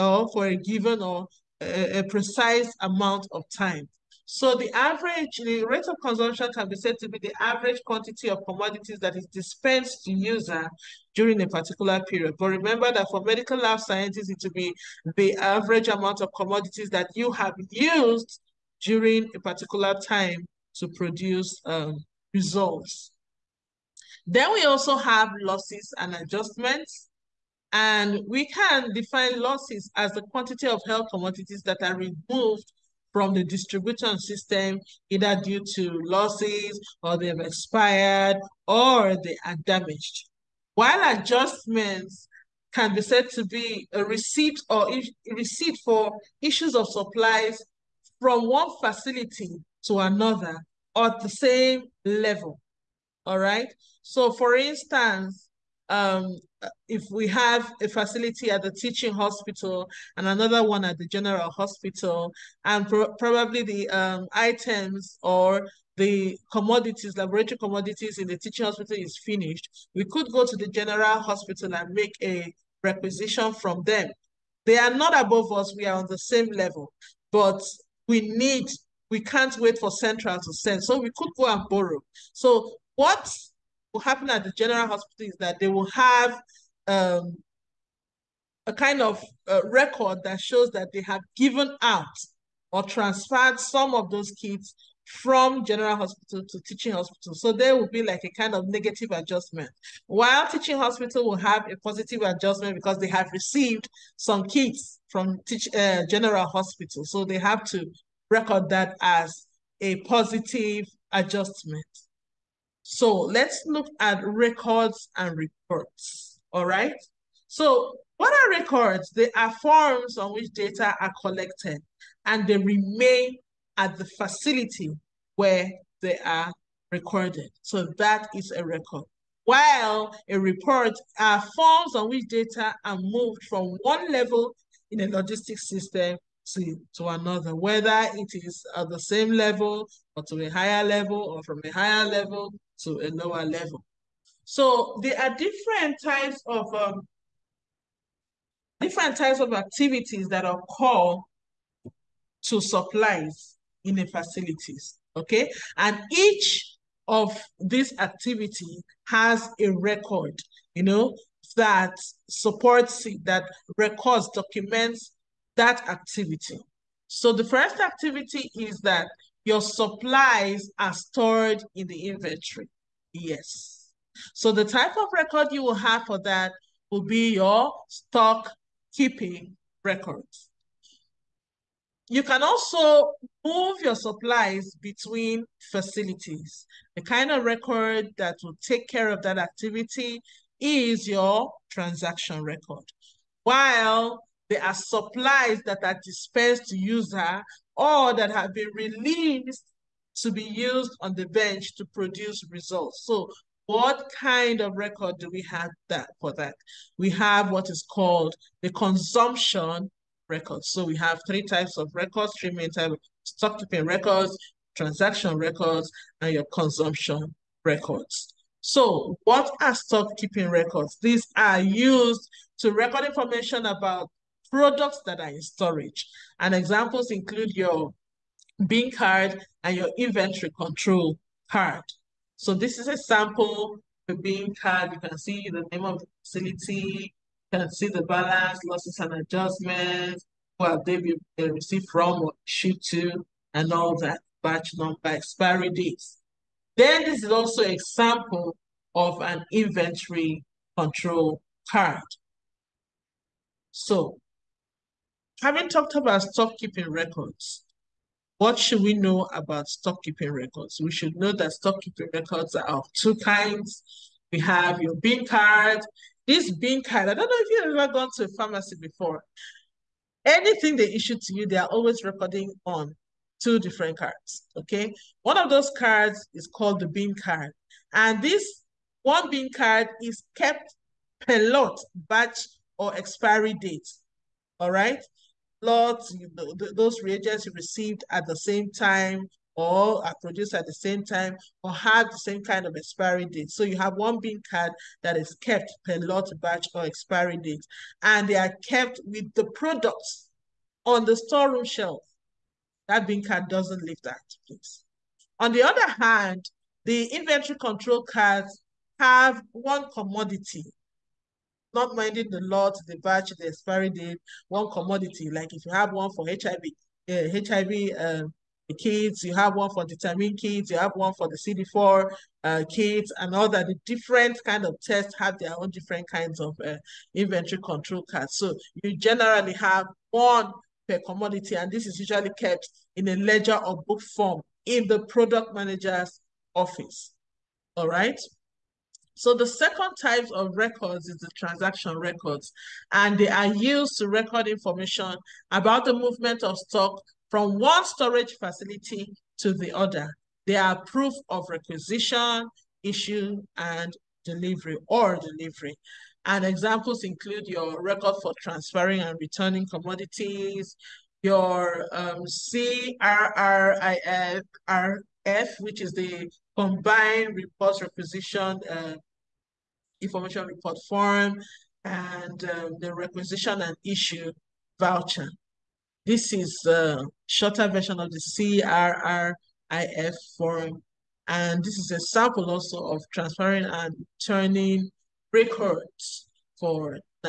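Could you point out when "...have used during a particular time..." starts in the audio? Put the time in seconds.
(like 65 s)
17 s.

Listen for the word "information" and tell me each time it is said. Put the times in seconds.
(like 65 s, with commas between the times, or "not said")
223 s, 344 s, 369 s.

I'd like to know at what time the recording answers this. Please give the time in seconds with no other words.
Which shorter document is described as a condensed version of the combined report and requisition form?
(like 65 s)
372 s.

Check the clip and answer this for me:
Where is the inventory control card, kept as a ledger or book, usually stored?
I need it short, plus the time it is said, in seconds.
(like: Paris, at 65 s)
Product manager's office, at 335 s.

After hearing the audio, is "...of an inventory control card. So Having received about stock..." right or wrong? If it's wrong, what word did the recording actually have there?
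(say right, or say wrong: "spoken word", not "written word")
wrong: "talked", not "received".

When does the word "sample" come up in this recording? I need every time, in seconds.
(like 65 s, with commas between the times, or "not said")
232 s, 381 s.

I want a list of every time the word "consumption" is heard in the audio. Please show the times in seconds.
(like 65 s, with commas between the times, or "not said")
6 s, 208 s, 216 s.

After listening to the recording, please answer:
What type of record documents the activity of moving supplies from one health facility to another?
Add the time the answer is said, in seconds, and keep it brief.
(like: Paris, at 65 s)
Transaction record, at 191 s.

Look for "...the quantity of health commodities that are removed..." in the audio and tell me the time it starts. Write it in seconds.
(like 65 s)
30 s.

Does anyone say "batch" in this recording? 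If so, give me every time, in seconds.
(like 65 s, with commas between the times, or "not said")
244 s, 281 s, 296 s, 312 s.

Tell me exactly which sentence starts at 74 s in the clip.
They are not above us, we are on the same level, but we need, we can't wait for central to send.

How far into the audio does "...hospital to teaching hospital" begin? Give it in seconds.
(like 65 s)
95 s.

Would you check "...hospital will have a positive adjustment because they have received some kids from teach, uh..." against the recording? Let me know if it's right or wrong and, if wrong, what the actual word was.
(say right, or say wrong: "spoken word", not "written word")
right.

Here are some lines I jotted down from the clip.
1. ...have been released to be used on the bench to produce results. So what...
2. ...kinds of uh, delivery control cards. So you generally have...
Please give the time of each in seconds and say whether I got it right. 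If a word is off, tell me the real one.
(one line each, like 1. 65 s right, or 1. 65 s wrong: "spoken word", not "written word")
1. 198 s right
2. 326 s wrong: "inventory", not "delivery".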